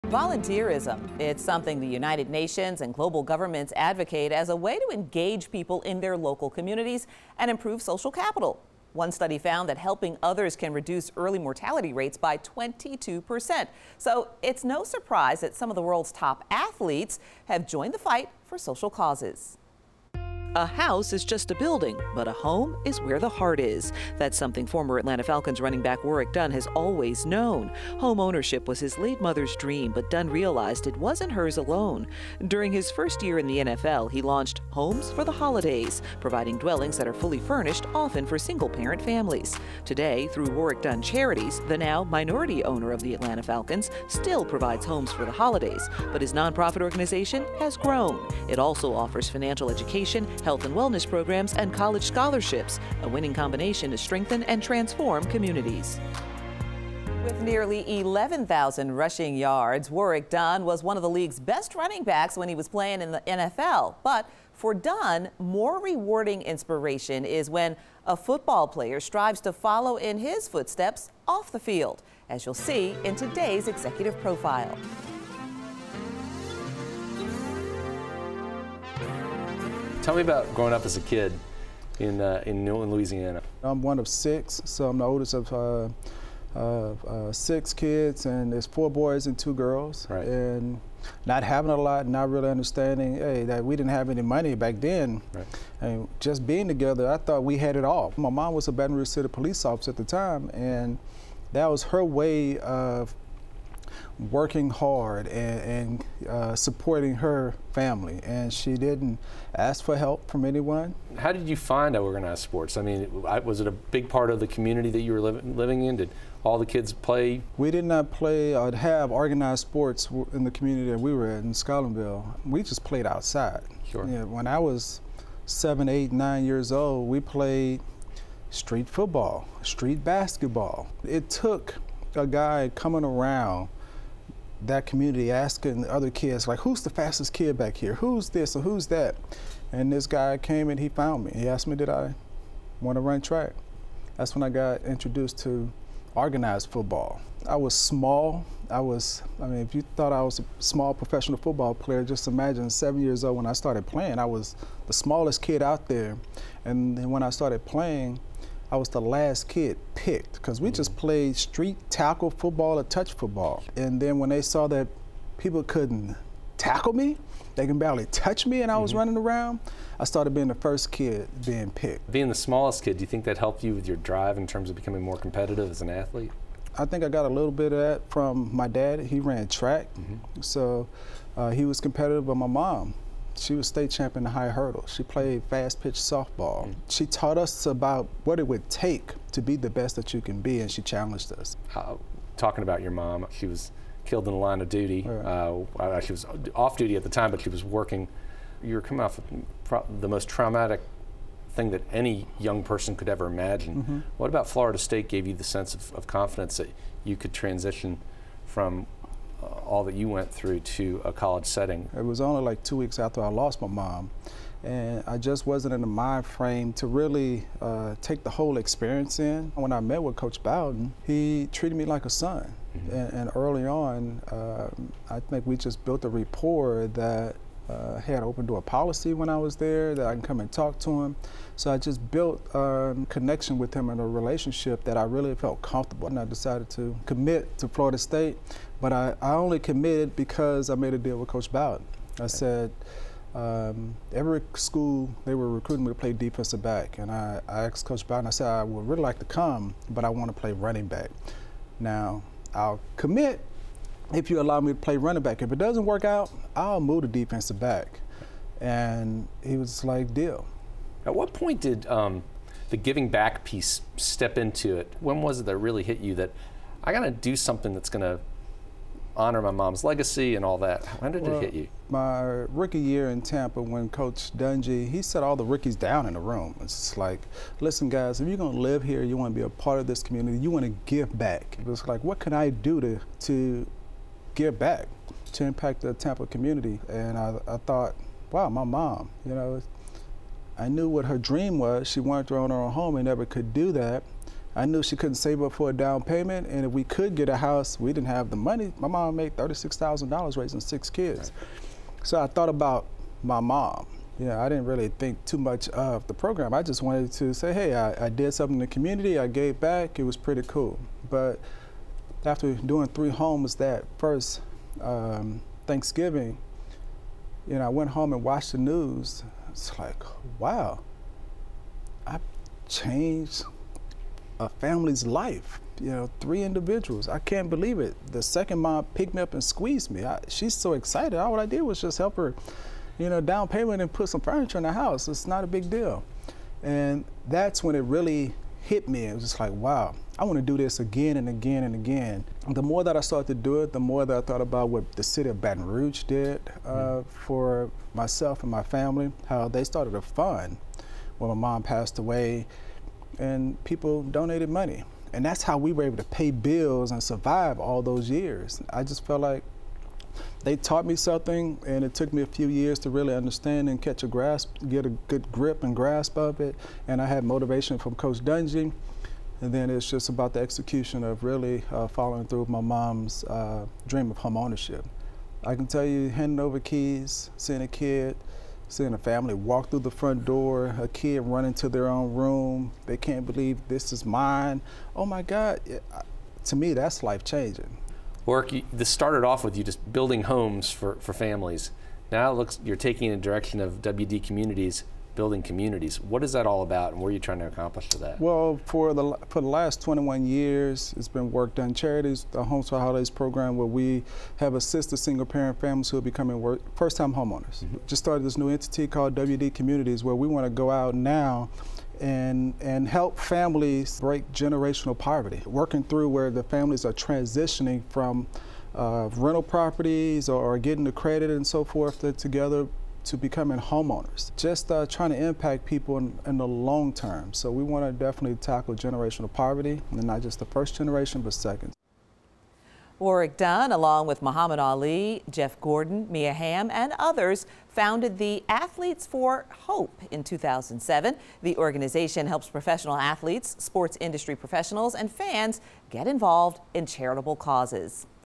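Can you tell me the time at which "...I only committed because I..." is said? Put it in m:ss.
3:59.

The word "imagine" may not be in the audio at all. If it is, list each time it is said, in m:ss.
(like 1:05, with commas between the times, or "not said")
2:32, 3:23.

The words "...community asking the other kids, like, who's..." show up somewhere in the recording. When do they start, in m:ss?
2:14.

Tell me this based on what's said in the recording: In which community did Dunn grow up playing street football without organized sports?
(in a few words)
Scotlandville.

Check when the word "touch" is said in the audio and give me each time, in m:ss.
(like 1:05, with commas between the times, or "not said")
2:42, 2:48.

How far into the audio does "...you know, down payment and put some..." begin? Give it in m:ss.
5:32.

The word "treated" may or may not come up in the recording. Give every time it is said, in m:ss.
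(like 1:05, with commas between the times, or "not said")
3:41.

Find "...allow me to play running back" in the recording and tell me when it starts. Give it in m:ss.
4:14.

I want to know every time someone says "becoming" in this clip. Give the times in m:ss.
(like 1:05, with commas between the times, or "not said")
2:54, 6:46, 7:03.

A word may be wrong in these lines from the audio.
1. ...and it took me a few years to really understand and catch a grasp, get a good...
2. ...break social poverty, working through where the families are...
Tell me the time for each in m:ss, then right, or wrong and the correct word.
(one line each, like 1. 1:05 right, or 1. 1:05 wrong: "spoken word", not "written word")
1. 6:01 right
2. 6:53 wrong: "generational", not "social".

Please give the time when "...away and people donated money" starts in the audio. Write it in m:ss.
5:51.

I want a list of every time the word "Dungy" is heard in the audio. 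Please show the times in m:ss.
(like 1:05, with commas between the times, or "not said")
4:34, 6:08.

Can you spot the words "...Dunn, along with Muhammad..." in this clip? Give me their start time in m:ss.
7:13.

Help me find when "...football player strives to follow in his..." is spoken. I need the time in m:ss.
1:08.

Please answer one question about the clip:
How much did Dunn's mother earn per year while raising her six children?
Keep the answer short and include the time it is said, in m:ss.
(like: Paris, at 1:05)
$36,000, at 4:59.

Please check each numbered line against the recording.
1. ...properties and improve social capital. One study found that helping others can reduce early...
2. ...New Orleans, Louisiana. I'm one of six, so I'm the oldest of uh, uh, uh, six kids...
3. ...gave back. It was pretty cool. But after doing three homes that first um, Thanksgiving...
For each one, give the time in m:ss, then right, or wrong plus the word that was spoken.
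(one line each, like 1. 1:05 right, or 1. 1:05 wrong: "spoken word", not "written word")
1. 0:06 wrong: "communities", not "properties"
2. 1:22 right
3. 5:09 right.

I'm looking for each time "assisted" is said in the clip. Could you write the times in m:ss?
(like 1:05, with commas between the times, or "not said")
6:44.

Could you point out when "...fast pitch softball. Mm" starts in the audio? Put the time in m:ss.
3:05.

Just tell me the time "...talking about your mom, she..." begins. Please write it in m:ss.
3:12.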